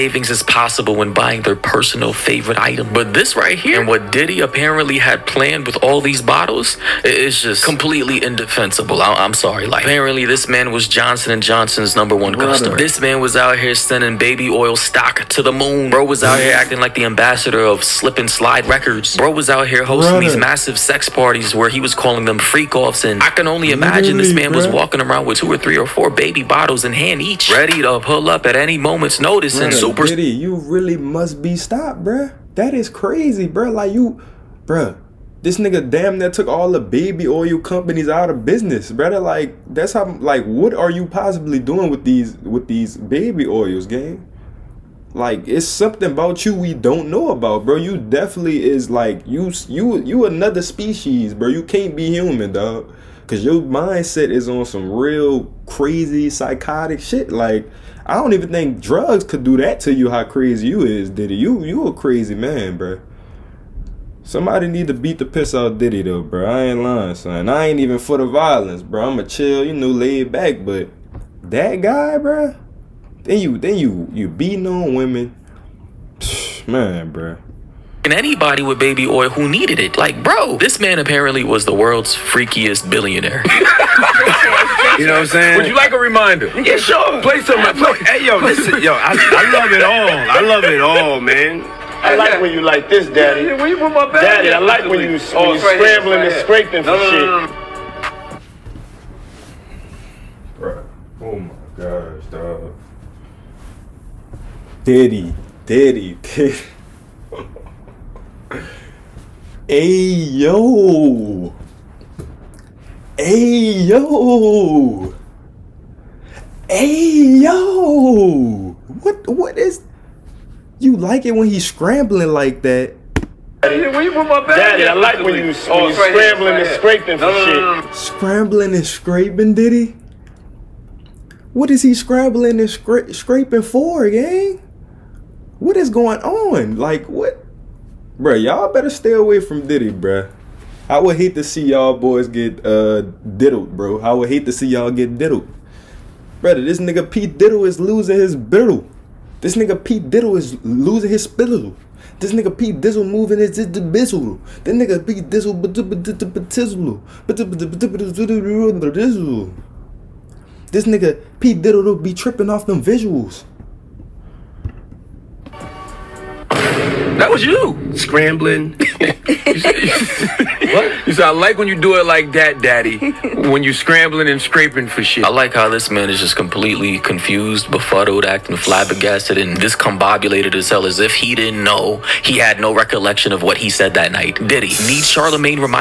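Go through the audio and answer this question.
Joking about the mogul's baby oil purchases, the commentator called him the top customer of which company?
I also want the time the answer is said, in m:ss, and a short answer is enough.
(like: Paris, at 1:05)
Johnson and Johnson, at 0:10.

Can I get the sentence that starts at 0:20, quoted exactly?
these massive sex parties where he was calling them freak offs.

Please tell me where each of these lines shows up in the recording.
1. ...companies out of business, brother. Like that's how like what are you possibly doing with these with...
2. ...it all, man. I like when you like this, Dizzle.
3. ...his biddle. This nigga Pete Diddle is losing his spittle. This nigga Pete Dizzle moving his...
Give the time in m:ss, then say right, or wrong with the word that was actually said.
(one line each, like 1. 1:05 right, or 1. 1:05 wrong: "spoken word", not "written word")
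1. 0:37 right
2. 1:30 wrong: "Daddy", not "Dizzle"
3. 2:28 right.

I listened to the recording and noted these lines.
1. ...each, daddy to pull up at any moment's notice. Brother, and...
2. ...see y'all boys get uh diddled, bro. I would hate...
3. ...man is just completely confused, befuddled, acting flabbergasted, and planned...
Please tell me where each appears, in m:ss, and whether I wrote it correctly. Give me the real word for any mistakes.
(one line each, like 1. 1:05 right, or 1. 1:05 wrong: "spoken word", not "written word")
1. 0:27 wrong: "ready", not "daddy"
2. 2:21 right
3. 2:55 wrong: "discombobulated", not "planned".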